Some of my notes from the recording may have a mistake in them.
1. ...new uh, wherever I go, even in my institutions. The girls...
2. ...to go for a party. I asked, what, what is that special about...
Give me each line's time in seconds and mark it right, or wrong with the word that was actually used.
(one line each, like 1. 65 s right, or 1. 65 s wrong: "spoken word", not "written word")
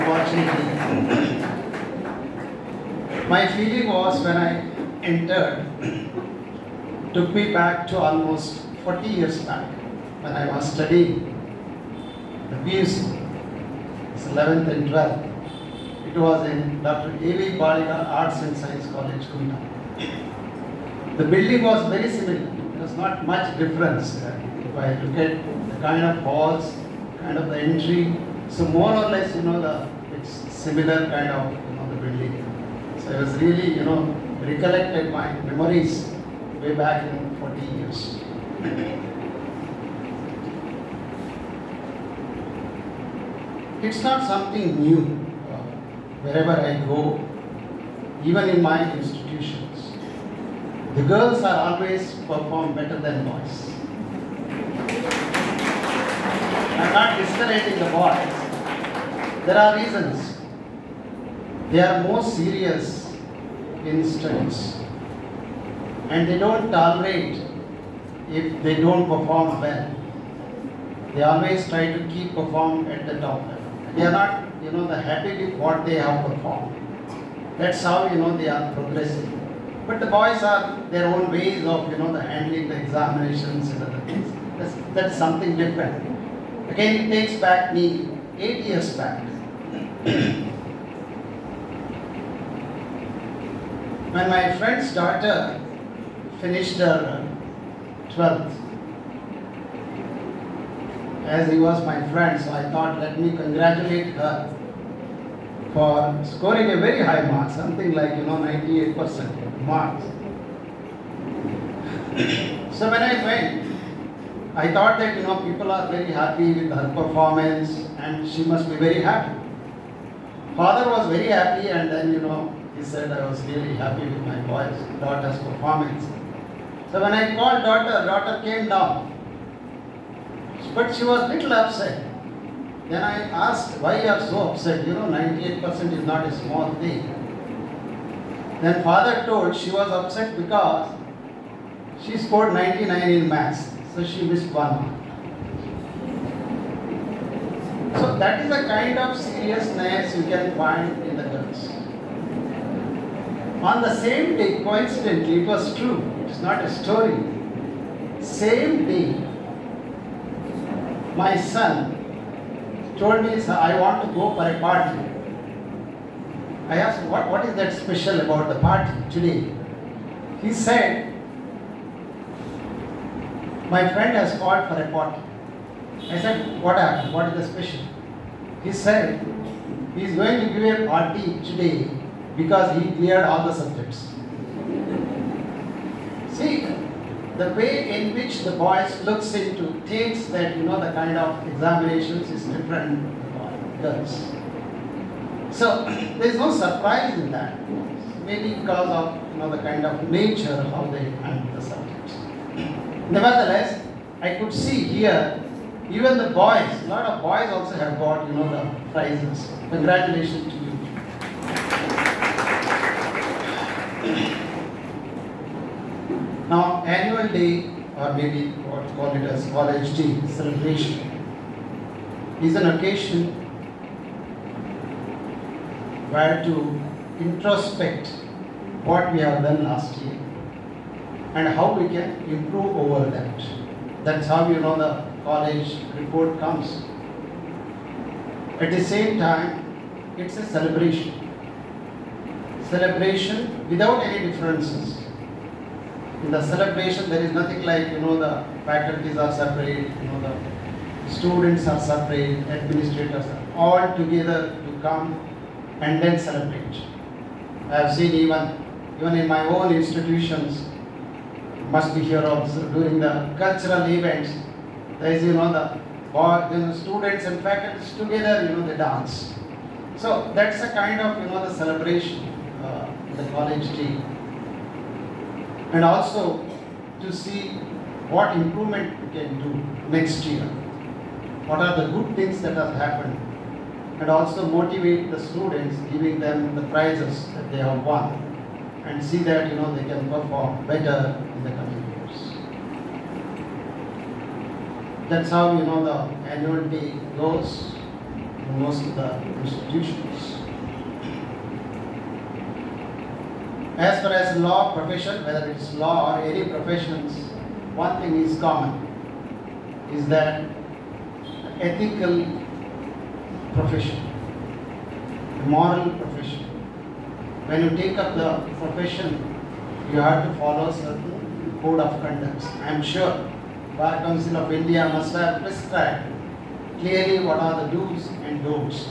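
1. 44 s right
2. 164 s right.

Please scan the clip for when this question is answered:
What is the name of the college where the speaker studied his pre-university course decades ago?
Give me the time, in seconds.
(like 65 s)
16 s.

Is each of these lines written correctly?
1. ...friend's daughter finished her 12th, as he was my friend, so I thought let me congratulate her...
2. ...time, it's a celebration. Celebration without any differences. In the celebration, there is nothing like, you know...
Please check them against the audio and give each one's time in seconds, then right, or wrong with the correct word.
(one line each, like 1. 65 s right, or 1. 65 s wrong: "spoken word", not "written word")
1. 94 s right
2. 239 s right.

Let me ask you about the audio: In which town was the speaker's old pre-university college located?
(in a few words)
Kumta.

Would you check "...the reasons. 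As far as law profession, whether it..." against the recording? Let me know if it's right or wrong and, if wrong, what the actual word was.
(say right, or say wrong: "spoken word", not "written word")
wrong: "institutions", not "reasons".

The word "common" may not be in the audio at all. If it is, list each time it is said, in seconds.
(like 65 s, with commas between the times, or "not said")
308 s.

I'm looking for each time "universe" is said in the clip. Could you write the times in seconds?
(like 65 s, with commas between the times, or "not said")
not said.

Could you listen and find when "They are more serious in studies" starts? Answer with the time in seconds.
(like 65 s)
61 s.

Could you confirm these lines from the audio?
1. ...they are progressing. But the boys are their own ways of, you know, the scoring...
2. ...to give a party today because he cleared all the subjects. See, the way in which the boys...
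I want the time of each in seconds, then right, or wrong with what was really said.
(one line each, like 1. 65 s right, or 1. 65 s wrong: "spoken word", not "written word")
1. 78 s wrong: "handling", not "scoring"
2. 180 s right.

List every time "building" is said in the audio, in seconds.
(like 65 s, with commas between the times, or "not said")
21 s, 32 s.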